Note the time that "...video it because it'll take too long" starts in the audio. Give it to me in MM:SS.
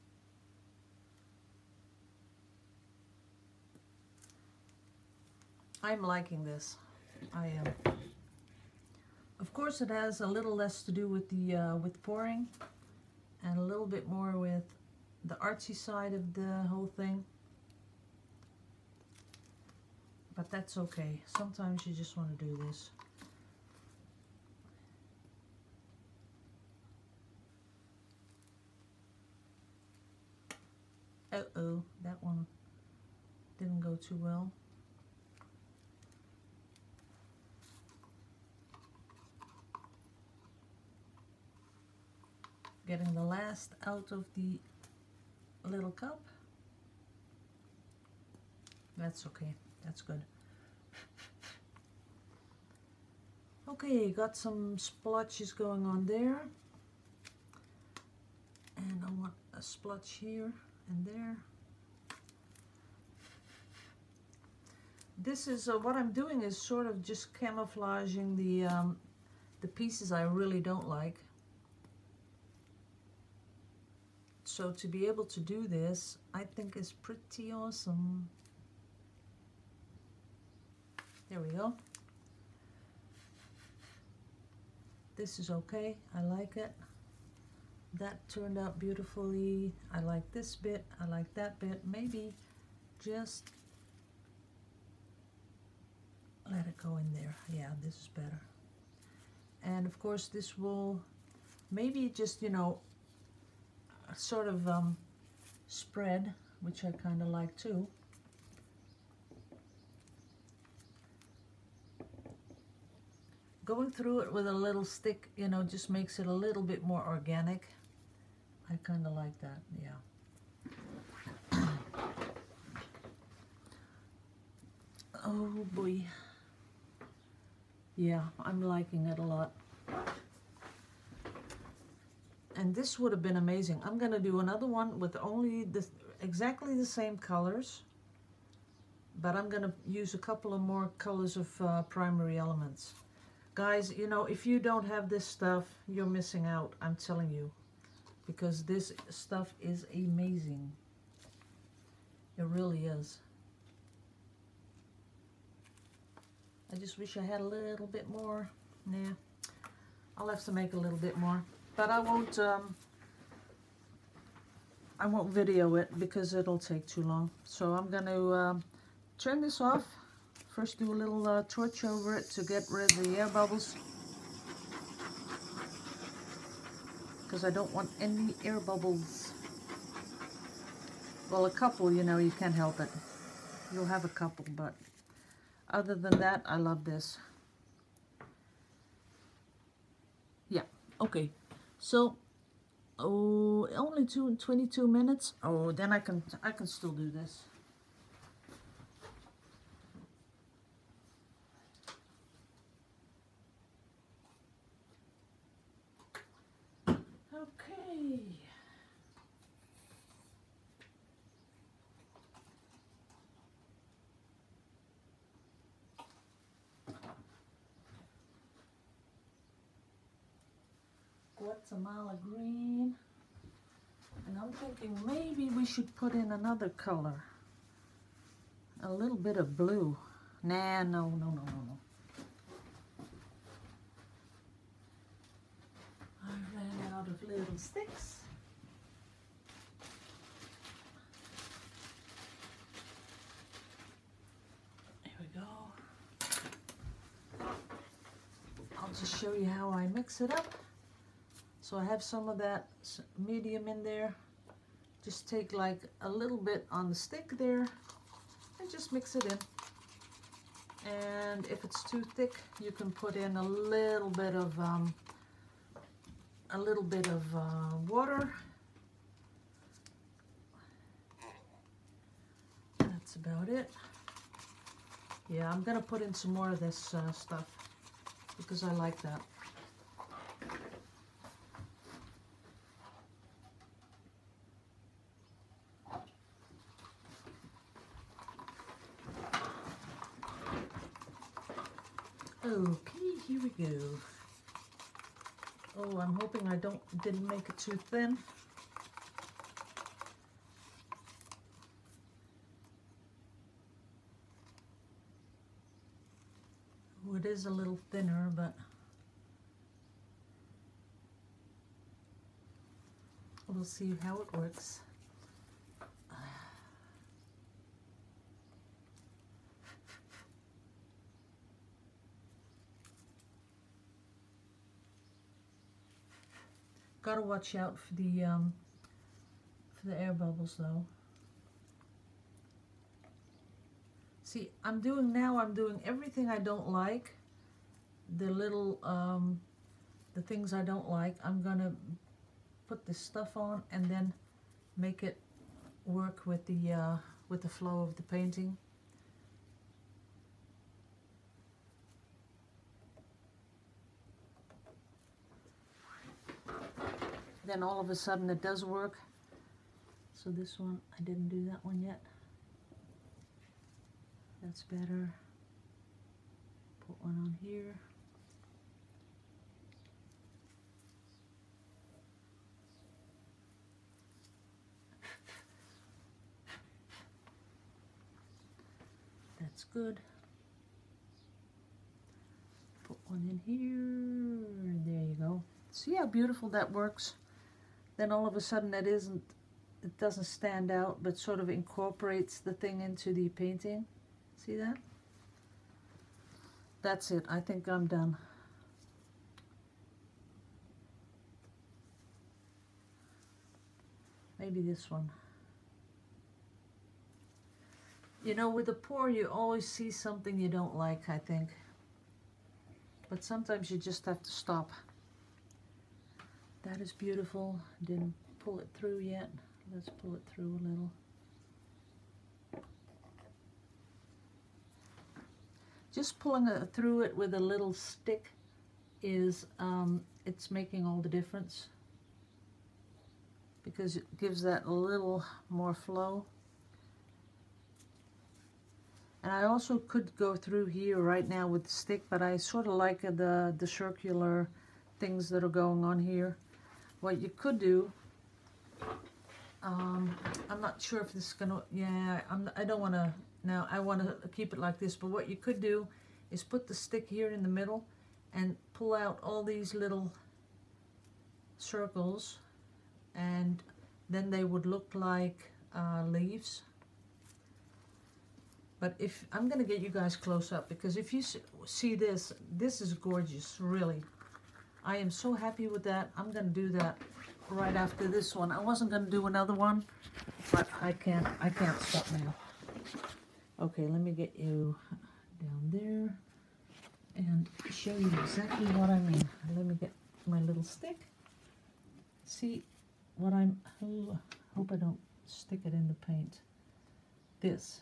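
02:45.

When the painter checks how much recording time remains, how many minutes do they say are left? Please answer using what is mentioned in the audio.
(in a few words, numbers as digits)
22.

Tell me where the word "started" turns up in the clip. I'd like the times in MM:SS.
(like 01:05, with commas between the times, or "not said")
not said.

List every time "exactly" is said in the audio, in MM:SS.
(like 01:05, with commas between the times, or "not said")
02:16, 08:08.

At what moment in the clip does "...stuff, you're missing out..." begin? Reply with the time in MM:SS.
02:25.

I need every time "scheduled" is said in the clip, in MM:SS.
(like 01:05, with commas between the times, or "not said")
not said.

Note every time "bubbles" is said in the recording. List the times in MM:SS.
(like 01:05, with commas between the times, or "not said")
02:53, 02:58, 05:30.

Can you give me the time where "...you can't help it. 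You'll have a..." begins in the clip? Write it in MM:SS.
03:02.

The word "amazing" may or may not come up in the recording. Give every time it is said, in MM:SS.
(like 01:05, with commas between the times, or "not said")
02:13, 02:29.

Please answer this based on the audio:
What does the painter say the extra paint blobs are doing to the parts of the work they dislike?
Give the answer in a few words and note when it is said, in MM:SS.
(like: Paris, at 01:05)
camouflaging, at 01:07.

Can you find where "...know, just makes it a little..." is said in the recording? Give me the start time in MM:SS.
01:55.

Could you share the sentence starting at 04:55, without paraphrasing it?
Oh, I'm hoping I don't didn't make it too thin.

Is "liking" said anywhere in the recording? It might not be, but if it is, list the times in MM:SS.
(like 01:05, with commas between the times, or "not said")
00:06, 02:08.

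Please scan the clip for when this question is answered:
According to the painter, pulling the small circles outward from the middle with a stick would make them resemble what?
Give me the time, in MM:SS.
07:46.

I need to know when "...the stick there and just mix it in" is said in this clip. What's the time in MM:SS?
04:16.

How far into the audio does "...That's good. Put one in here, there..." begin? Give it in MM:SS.
06:19.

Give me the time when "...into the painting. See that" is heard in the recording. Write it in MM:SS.
06:32.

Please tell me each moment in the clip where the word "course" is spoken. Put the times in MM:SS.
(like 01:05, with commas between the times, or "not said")
00:09, 01:39.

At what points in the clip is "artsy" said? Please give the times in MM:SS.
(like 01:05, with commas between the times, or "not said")
00:15.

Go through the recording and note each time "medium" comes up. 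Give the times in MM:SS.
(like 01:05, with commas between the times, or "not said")
04:13.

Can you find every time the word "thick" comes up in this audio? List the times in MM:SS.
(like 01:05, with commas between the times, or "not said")
04:22.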